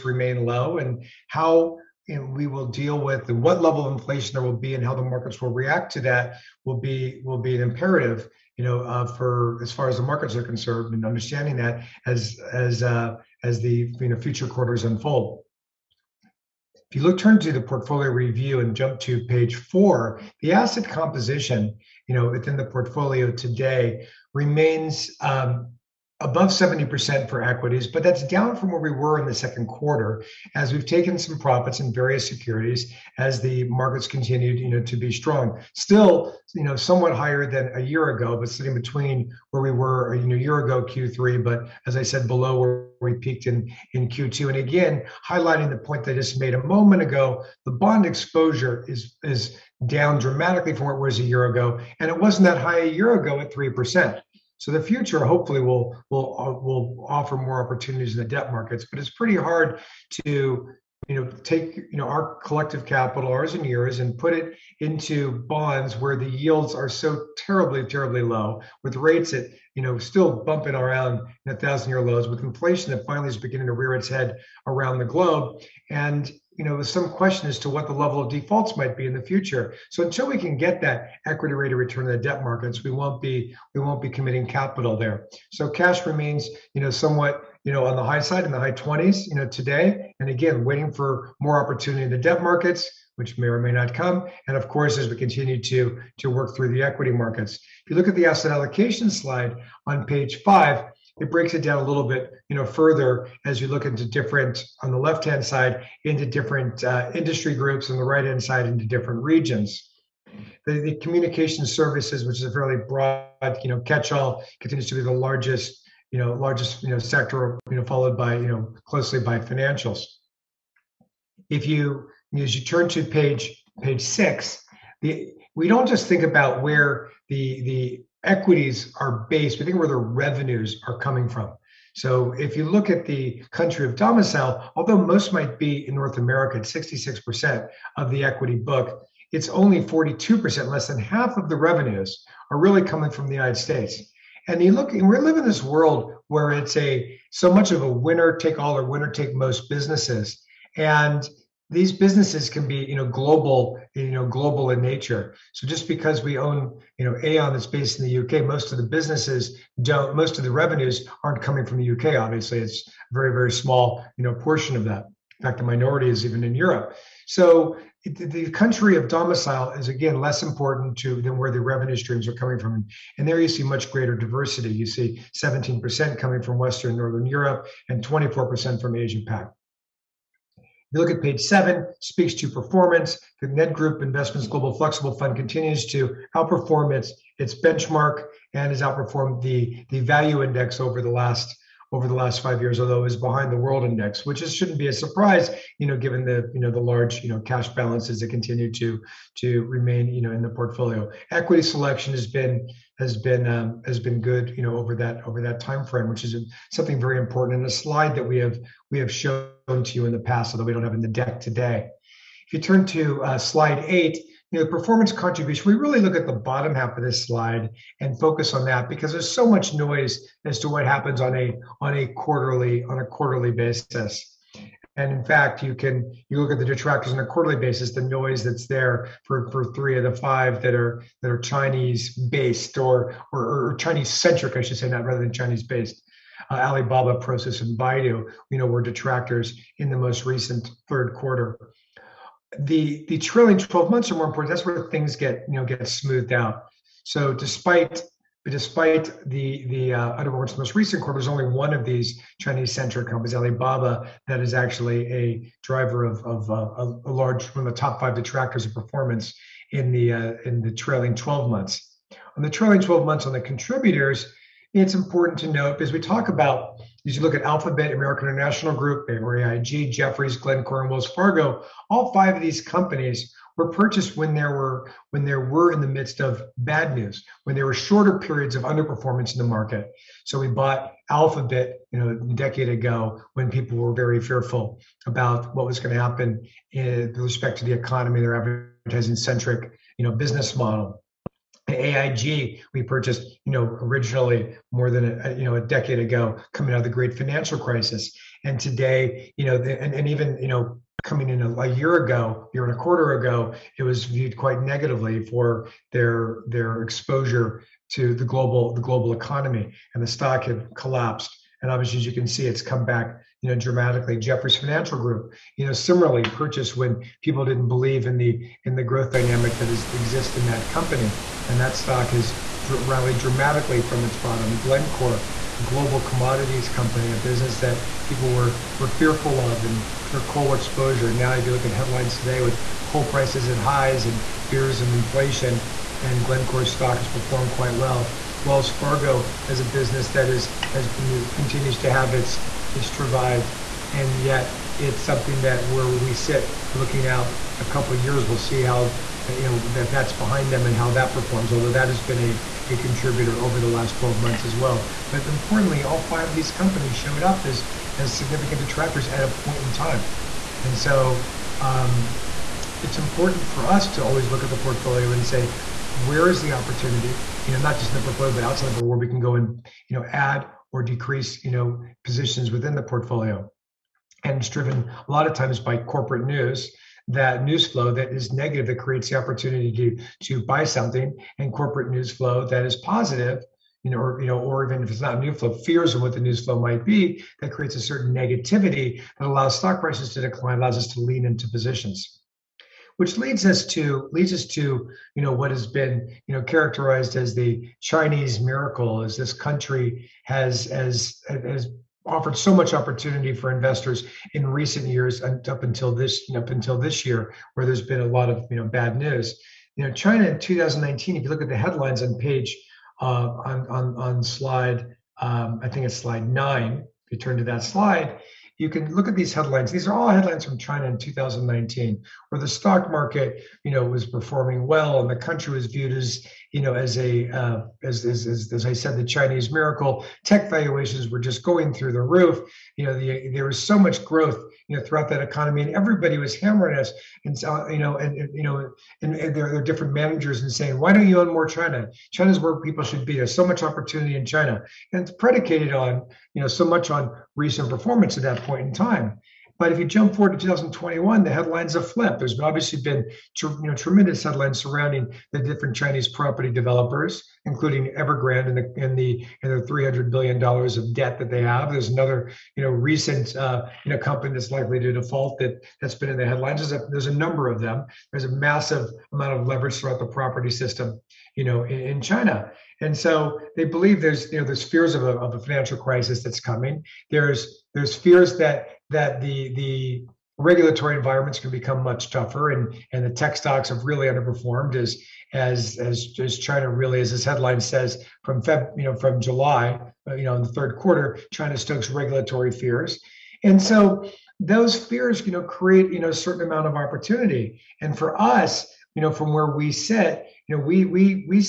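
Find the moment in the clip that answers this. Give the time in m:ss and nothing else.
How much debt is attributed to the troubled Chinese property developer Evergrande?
7:39.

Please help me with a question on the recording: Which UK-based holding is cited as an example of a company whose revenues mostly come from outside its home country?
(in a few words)
Aon.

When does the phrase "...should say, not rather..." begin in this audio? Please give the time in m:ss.
3:54.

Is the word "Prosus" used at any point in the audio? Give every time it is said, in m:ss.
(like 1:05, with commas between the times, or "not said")
3:57.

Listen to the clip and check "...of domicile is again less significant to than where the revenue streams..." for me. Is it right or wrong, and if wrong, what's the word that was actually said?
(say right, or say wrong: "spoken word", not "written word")
wrong: "important", not "significant".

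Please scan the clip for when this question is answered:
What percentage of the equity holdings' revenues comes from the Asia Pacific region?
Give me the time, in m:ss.
2:58.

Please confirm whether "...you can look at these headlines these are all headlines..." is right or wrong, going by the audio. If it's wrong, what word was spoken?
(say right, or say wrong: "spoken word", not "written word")
right.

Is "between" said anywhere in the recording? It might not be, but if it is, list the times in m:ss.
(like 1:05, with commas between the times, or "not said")
0:38.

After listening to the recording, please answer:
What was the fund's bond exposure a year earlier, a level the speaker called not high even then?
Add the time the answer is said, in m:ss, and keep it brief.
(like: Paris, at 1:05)
3%, at 0:53.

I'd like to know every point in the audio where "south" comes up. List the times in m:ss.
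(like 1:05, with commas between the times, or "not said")
not said.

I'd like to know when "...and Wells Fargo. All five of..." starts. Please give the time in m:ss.
4:30.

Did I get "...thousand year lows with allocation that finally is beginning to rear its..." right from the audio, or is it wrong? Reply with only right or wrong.
wrong.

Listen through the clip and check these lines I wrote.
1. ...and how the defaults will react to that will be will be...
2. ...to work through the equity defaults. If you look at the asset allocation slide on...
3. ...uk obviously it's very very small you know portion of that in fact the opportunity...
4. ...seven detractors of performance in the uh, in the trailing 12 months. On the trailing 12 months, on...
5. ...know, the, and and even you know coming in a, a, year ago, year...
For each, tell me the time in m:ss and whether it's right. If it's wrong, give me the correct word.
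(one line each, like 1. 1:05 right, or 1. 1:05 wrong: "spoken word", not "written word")
1. 0:04 wrong: "markets", not "defaults"
2. 1:36 wrong: "markets", not "defaults"
3. 2:41 wrong: "minority", not "opportunity"
4. 4:18 wrong: "five", not "seven"
5. 4:59 right.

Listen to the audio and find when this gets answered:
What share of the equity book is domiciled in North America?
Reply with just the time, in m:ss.
2:16.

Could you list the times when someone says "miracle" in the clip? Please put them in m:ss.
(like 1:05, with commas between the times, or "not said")
6:38, 7:09.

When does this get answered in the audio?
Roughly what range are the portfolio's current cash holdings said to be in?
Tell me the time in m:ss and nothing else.
1:28.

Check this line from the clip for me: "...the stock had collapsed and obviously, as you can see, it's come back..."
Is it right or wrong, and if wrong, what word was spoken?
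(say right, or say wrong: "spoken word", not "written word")
right.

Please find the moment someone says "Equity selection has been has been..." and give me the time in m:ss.
3:21.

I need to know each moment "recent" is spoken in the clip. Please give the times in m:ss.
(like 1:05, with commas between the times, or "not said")
4:00, 4:10, 6:44, 7:27, 7:42.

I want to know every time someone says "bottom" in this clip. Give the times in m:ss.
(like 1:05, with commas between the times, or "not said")
3:36, 5:24.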